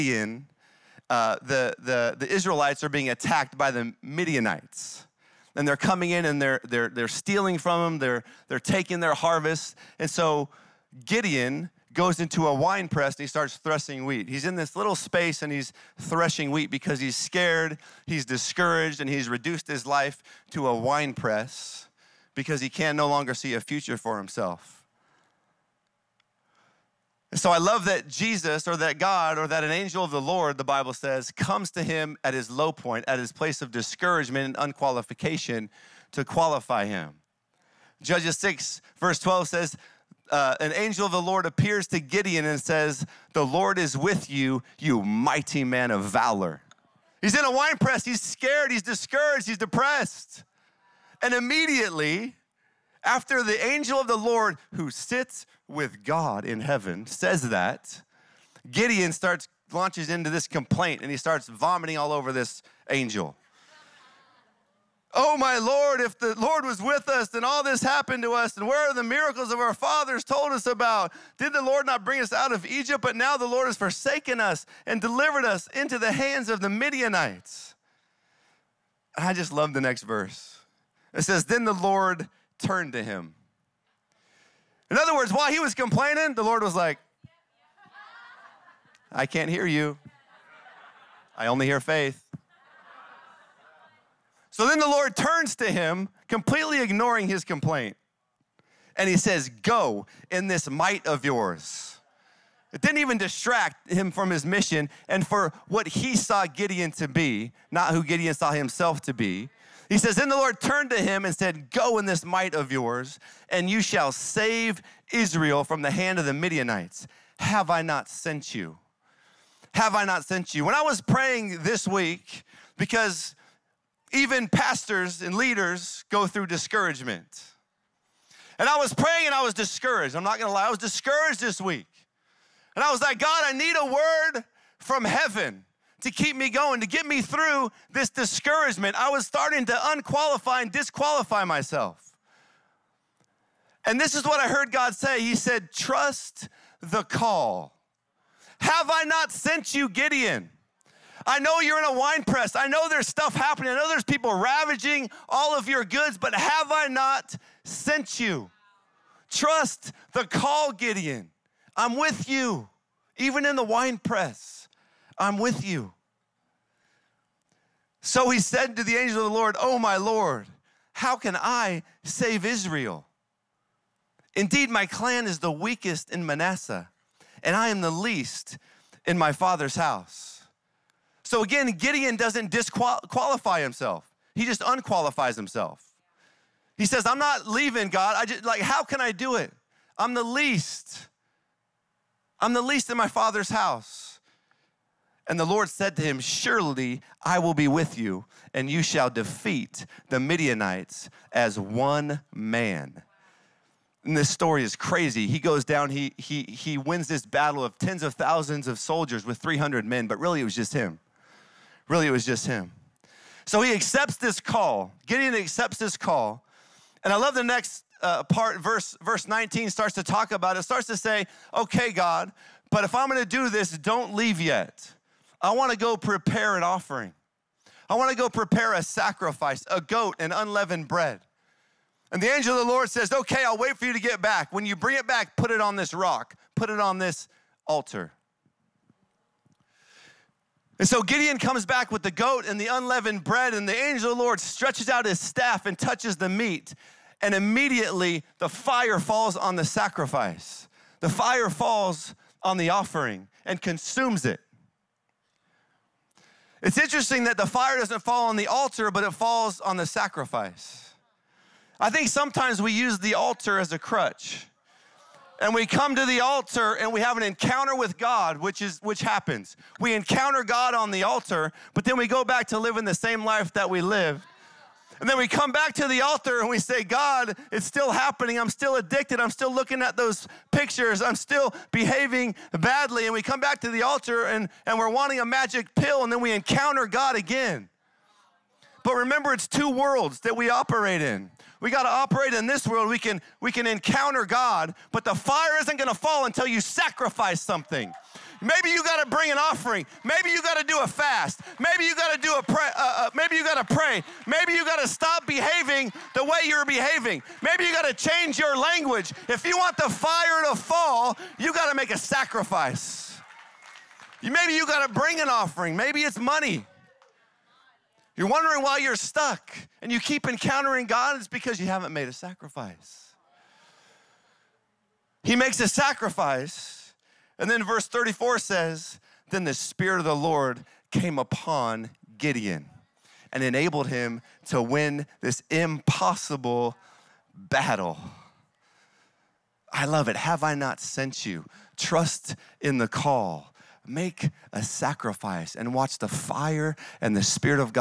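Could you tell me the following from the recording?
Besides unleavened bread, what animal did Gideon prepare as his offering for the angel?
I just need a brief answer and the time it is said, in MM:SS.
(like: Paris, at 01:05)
A goat, at 03:49.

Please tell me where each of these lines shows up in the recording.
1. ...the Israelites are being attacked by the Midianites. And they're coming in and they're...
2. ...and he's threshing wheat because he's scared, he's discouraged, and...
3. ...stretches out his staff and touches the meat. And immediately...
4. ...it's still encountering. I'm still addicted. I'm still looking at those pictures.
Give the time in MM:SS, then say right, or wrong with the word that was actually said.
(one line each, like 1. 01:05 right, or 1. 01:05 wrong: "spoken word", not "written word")
1. 00:02 right
2. 00:15 right
3. 04:04 right
4. 04:37 wrong: "happening", not "encountering".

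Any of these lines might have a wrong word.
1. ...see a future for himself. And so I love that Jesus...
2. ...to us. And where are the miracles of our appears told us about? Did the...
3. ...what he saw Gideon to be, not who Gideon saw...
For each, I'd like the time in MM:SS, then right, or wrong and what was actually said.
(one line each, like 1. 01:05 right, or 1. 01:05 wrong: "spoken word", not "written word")
1. 00:23 right
2. 01:08 wrong: "fathers", not "appears"
3. 01:45 right.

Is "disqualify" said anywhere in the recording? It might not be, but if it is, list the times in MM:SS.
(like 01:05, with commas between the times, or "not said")
02:20, 03:02.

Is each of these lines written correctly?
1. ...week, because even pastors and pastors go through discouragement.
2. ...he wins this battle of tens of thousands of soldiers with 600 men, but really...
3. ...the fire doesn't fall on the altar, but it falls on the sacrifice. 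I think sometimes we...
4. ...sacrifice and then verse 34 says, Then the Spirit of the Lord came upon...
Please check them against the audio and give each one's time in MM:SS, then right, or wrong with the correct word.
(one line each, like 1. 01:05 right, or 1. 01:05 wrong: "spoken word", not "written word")
1. 02:01 wrong: "leaders", not "pastors"
2. 03:26 wrong: "300", not "600"
3. 04:17 right
4. 05:25 right.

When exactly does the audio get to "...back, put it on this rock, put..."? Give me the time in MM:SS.
03:55.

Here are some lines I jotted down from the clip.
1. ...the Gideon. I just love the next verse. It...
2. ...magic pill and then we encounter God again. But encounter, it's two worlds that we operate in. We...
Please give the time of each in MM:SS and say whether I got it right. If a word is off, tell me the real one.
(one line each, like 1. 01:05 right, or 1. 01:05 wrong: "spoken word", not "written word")
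1. 01:16 wrong: "Midianites", not "Gideon"
2. 04:45 wrong: "remember", not "encounter".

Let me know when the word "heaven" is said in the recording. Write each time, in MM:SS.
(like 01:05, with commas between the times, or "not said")
00:56, 02:15.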